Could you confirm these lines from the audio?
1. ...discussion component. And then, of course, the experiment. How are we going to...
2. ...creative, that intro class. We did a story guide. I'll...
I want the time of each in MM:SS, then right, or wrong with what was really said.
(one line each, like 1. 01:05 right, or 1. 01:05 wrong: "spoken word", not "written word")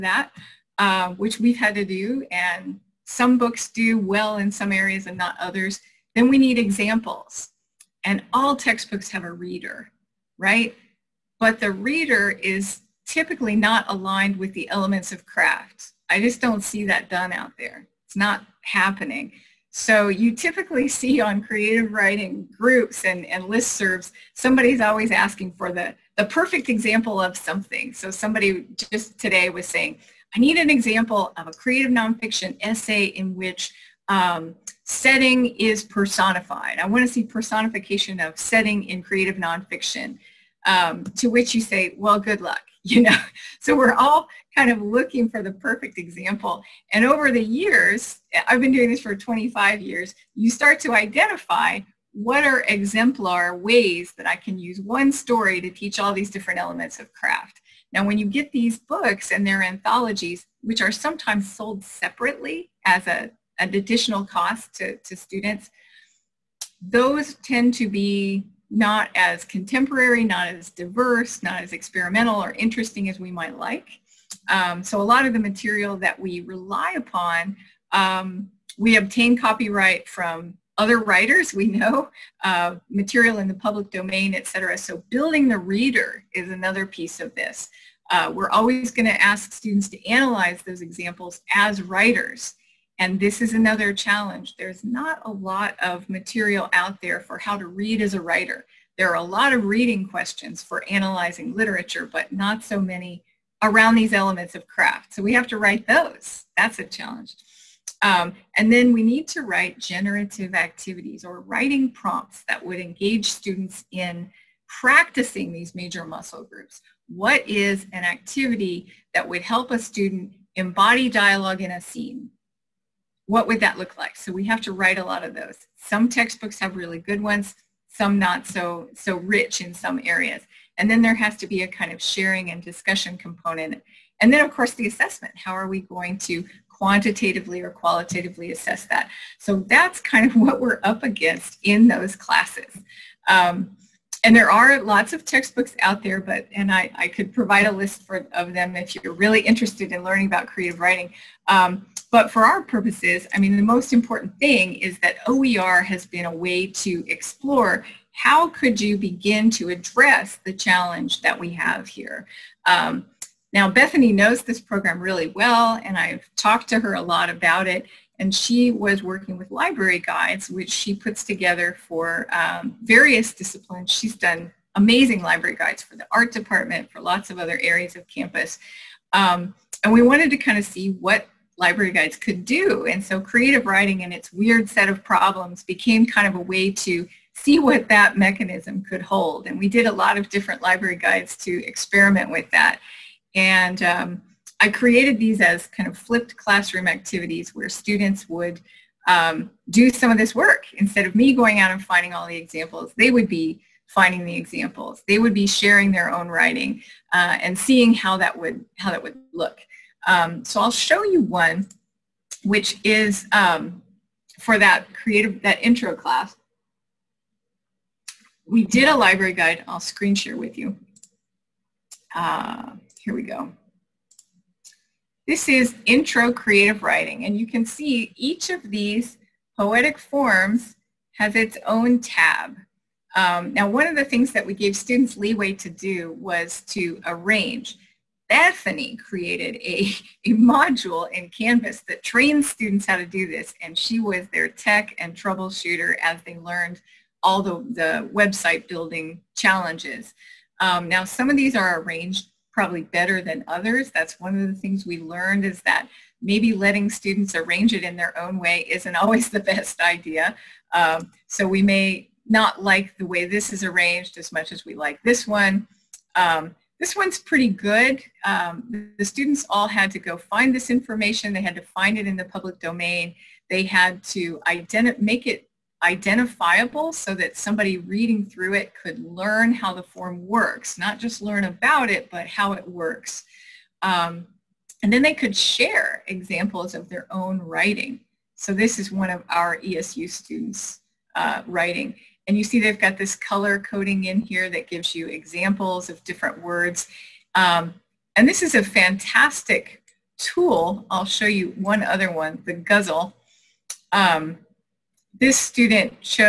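1. 02:12 wrong: "assessment", not "experiment"
2. 03:34 wrong: "library", not "story".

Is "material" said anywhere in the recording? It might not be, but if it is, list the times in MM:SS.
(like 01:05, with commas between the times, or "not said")
01:15, 01:22, 01:36.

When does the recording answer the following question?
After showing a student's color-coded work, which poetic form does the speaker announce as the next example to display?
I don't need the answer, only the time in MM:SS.
05:02.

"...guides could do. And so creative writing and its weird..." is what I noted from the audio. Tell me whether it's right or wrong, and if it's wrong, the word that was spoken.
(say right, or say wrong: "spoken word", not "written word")
right.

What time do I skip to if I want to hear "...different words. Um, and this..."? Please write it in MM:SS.
04:56.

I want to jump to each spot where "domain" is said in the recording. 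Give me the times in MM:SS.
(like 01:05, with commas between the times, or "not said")
01:23, 04:32.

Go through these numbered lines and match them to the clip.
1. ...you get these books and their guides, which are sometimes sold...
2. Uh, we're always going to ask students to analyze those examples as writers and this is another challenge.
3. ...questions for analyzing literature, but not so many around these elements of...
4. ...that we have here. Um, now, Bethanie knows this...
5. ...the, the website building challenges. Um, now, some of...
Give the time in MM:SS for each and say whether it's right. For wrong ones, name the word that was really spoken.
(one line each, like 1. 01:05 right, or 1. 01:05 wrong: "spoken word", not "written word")
1. 00:58 wrong: "anthologies", not "guides"
2. 01:28 right
3. 01:40 right
4. 02:41 right
5. 04:07 right.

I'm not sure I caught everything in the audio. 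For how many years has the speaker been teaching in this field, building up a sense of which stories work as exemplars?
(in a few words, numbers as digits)
25.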